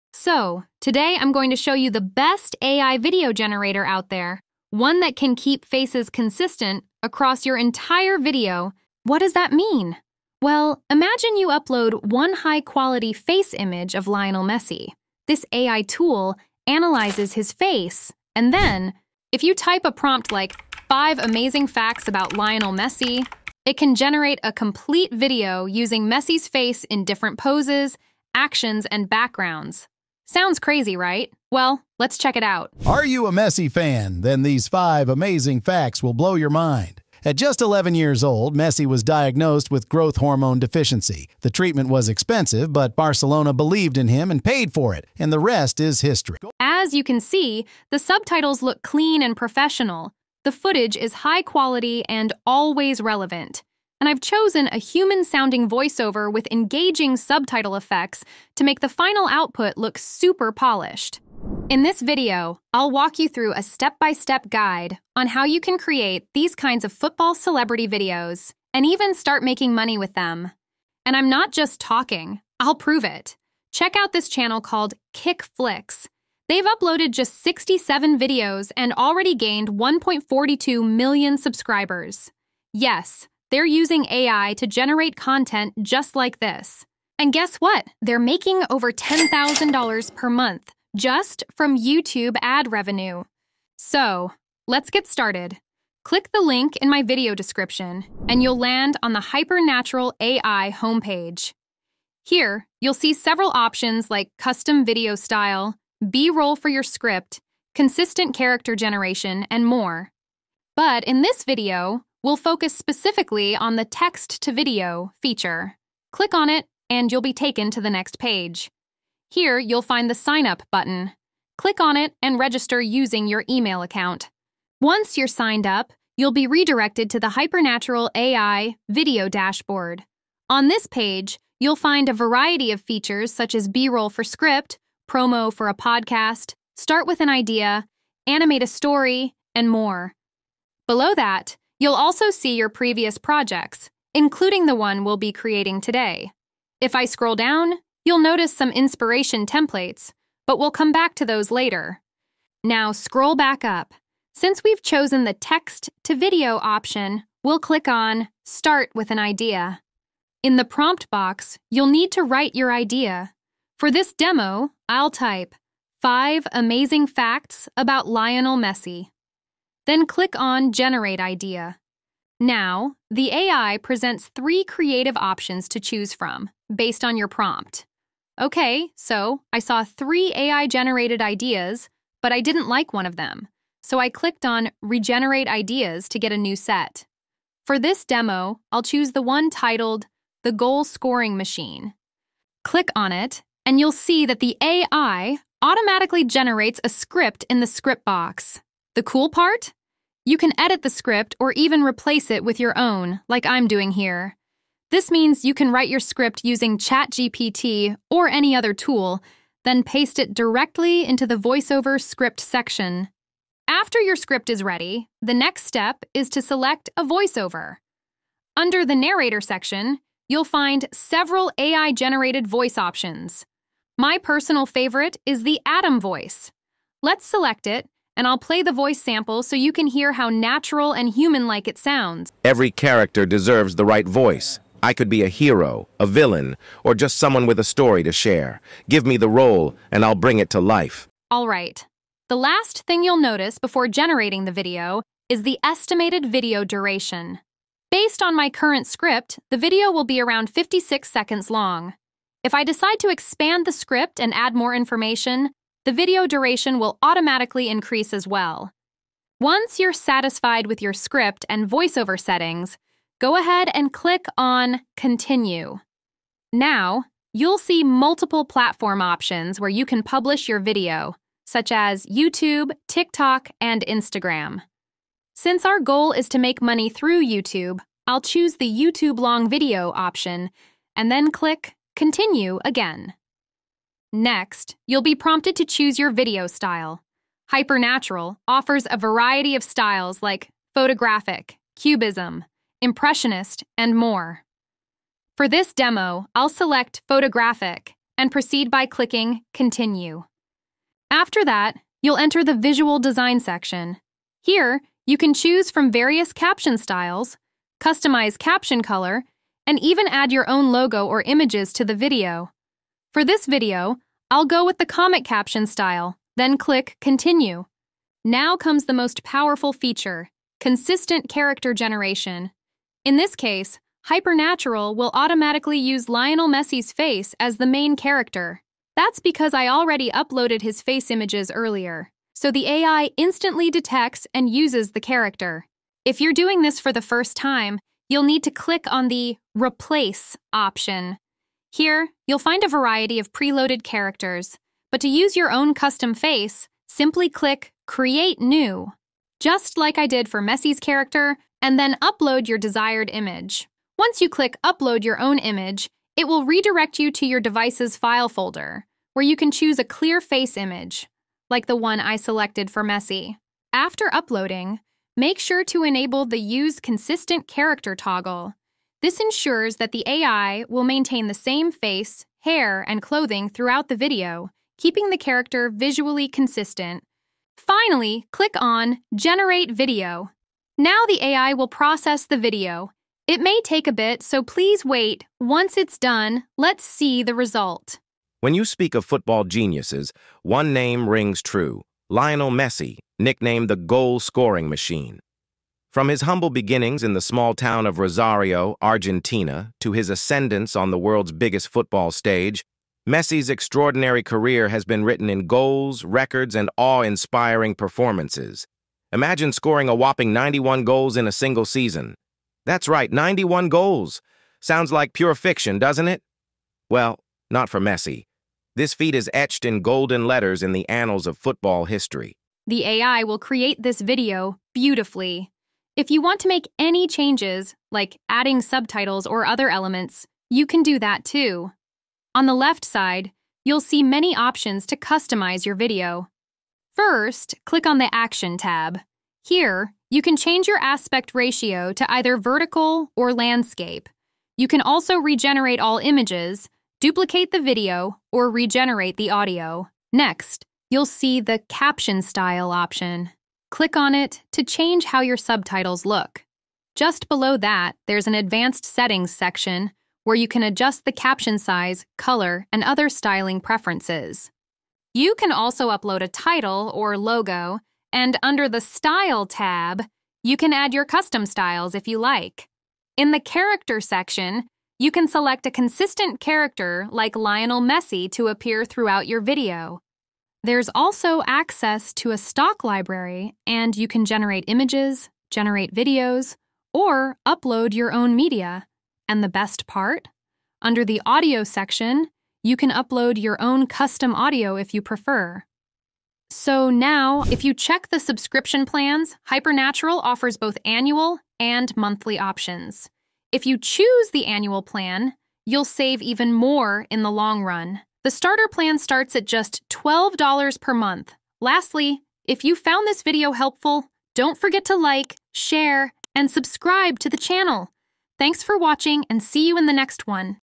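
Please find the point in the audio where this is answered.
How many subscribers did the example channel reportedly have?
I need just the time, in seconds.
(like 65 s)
79 s.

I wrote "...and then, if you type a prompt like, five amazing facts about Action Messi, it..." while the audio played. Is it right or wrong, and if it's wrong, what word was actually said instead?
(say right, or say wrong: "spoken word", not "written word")
wrong: "Lionel", not "Action".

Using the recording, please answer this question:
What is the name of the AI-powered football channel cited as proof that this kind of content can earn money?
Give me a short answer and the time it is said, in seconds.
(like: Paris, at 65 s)
Kick Flicks, at 75 s.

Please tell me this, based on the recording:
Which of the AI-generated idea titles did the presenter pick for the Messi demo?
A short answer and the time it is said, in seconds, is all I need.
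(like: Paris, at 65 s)
The Goal Scoring Machine, at 190 s.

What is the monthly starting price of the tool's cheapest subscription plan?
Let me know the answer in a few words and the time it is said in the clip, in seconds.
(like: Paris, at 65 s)
$12, at 509 s.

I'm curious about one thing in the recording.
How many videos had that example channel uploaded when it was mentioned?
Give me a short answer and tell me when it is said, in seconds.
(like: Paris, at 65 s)
67, at 77 s.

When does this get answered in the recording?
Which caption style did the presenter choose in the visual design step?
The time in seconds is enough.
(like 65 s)
314 s.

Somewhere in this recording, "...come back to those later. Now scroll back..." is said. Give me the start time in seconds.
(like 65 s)
150 s.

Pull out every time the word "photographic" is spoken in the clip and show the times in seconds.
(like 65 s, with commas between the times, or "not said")
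290 s, 297 s.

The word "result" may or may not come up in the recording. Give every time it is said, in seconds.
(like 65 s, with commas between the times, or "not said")
387 s.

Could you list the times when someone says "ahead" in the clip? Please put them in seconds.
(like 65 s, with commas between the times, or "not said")
263 s.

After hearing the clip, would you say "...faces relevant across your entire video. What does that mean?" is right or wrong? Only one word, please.
wrong.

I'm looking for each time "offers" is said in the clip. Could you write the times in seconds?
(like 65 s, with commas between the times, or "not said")
288 s, 500 s.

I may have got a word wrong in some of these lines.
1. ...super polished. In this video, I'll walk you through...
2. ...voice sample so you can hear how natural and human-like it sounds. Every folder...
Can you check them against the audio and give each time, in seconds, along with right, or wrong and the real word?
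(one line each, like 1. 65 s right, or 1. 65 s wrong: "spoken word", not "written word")
1. 59 s right
2. 228 s wrong: "character", not "folder".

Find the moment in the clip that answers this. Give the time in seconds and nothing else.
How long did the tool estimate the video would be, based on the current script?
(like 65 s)
250 s.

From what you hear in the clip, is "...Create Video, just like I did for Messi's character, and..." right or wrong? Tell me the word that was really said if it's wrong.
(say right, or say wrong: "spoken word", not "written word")
wrong: "New", not "Video".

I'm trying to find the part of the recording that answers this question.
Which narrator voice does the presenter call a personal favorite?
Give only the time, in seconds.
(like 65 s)
225 s.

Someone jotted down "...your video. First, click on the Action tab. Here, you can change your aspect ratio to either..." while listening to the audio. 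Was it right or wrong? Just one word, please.
right.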